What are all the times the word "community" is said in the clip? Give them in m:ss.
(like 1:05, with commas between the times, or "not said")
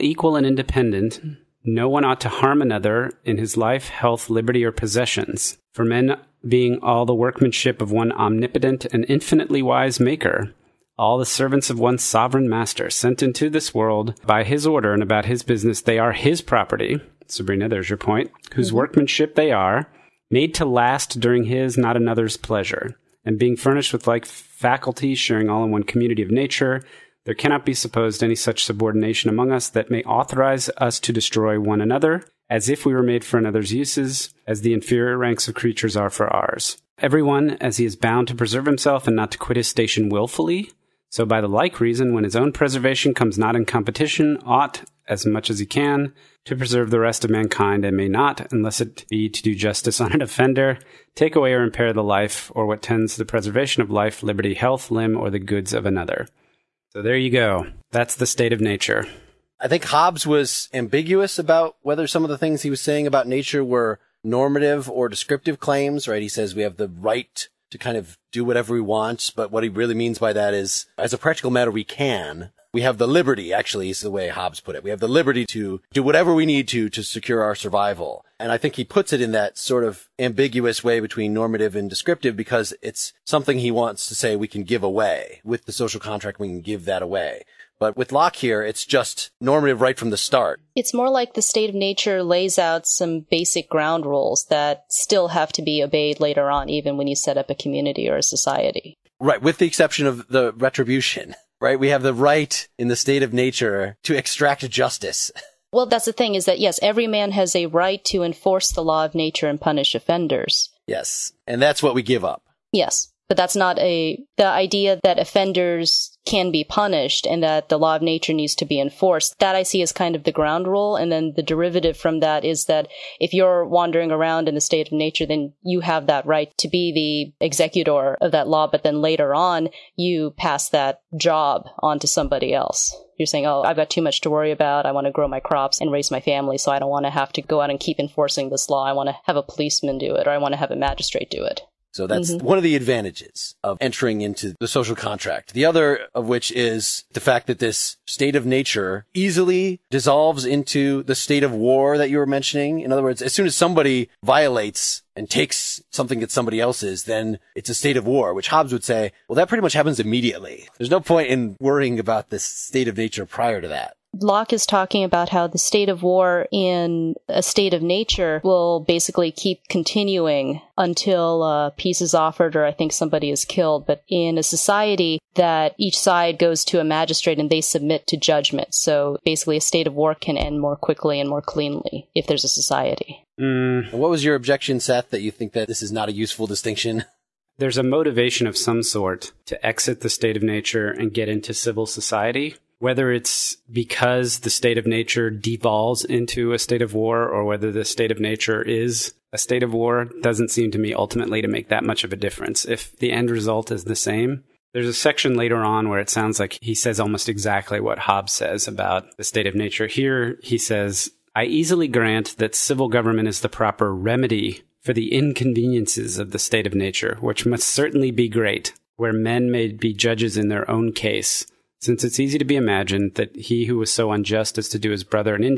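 0:25, 1:37.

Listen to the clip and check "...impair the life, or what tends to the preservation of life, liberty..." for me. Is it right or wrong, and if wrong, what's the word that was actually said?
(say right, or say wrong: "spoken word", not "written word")
right.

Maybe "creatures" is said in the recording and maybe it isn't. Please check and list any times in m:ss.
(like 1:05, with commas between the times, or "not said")
0:35.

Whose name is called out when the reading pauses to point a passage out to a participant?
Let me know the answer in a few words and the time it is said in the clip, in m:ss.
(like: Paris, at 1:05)
Sabrina, at 0:17.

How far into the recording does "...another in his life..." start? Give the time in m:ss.
0:02.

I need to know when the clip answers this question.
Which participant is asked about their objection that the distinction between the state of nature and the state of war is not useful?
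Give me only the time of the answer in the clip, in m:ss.
3:04.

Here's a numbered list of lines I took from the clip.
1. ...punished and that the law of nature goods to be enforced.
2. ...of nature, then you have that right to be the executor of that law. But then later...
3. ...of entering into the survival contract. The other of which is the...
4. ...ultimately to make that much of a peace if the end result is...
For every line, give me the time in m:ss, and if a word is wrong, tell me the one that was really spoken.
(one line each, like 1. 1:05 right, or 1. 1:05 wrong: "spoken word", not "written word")
1. 1:56 wrong: "needs", not "goods"
2. 2:04 right
3. 2:23 wrong: "social", not "survival"
4. 3:20 wrong: "difference", not "peace".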